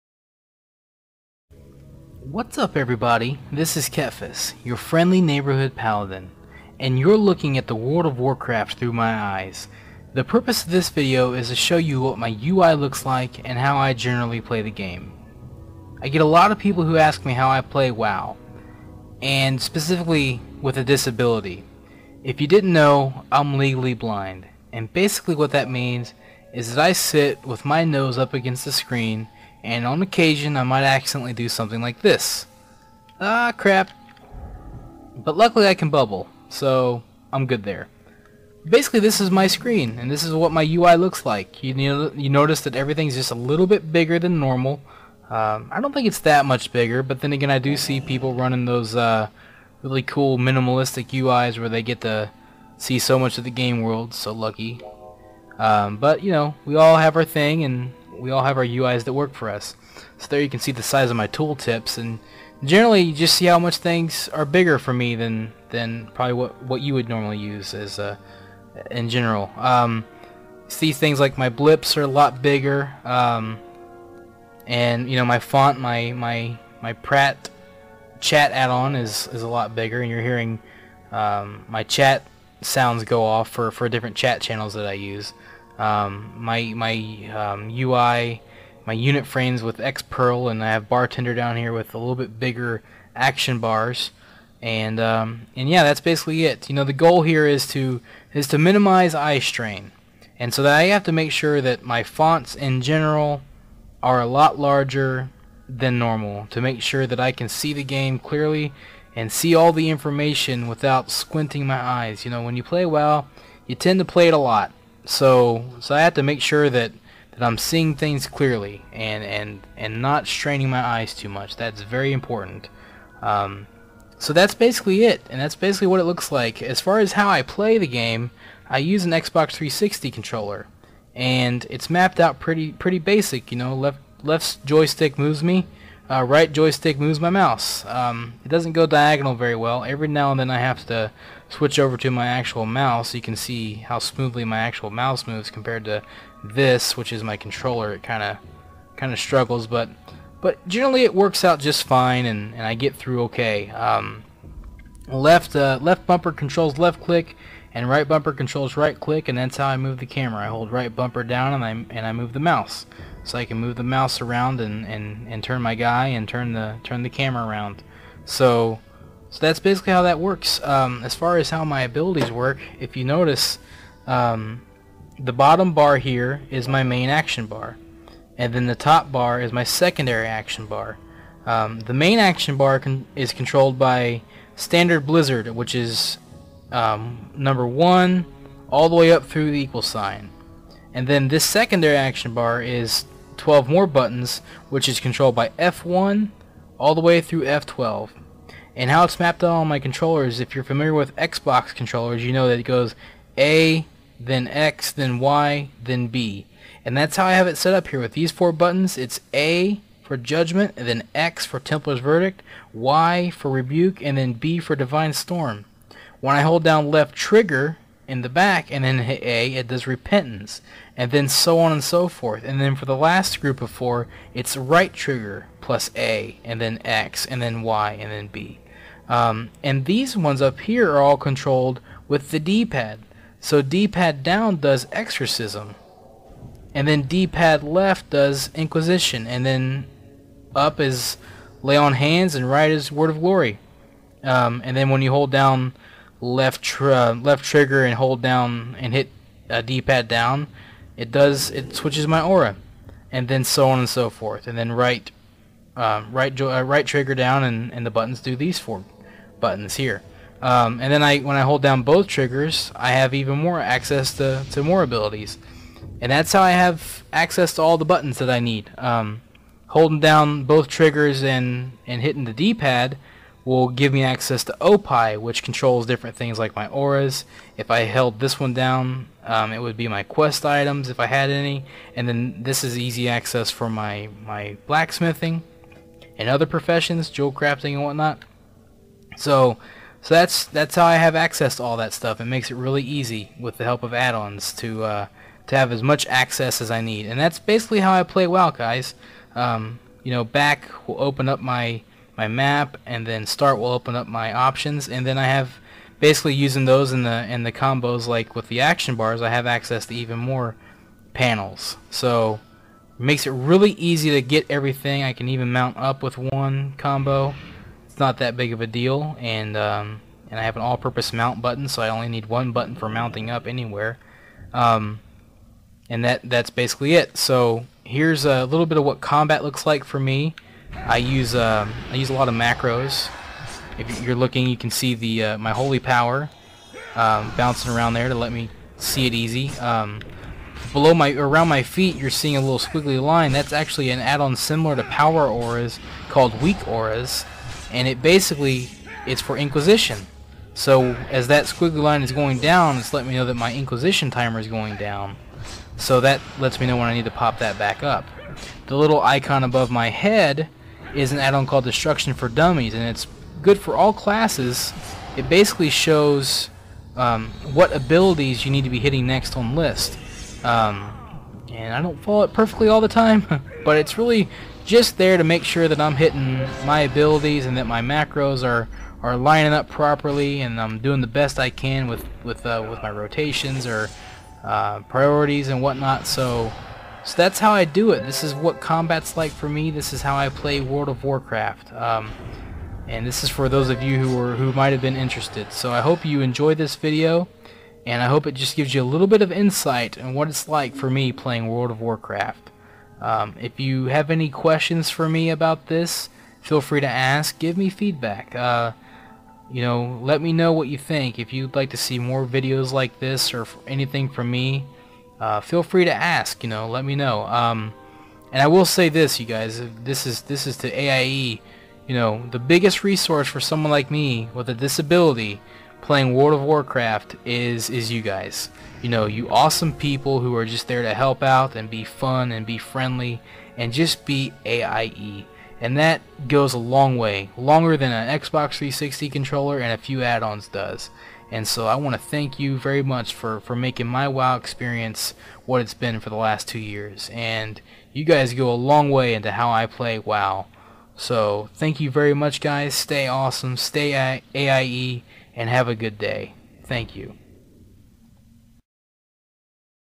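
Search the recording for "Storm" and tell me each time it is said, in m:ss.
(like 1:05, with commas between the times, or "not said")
3:35.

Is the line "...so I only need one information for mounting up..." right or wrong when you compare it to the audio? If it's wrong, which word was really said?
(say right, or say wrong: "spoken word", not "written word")
wrong: "button", not "information".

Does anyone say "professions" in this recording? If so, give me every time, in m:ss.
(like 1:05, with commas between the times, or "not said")
4:46.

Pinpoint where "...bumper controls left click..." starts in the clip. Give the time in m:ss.
2:36.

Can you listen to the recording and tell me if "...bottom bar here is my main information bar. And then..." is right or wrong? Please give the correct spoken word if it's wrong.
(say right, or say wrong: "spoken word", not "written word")
wrong: "action", not "information".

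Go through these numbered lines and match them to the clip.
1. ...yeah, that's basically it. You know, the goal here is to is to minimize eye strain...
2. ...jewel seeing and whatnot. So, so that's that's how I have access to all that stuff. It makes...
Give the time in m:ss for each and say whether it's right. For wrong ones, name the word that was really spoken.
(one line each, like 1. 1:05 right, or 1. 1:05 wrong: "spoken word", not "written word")
1. 1:35 right
2. 4:47 wrong: "crafting", not "seeing".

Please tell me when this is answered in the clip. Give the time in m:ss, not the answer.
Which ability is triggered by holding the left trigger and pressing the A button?
3:39.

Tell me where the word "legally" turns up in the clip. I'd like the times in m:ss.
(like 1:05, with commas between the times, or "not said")
0:23.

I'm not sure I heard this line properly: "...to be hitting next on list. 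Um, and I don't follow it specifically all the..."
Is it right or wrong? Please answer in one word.
wrong.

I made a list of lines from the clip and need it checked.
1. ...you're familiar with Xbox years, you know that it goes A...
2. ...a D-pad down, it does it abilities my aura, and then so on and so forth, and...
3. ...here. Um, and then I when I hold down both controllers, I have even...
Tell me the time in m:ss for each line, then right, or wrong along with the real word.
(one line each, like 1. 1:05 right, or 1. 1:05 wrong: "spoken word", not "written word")
1. 3:20 wrong: "controllers", not "years"
2. 4:09 wrong: "switches", not "abilities"
3. 4:19 wrong: "triggers", not "controllers".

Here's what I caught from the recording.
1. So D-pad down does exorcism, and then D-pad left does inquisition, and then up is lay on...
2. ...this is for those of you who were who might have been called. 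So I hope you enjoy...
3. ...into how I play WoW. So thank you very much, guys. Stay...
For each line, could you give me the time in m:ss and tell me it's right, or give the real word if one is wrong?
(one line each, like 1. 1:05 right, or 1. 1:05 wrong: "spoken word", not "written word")
1. 3:53 right
2. 6:33 wrong: "interested", not "called"
3. 7:29 right.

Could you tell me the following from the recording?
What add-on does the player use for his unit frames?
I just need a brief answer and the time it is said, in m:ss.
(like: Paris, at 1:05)
Xpearl, at 1:29.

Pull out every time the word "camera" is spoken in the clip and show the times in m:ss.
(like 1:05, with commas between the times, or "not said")
2:40, 2:47.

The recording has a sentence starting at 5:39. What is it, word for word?
Um, below my around my feet, you're seeing a little squiggly line.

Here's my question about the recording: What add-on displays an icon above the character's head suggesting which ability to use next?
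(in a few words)
Destruction for Dummies.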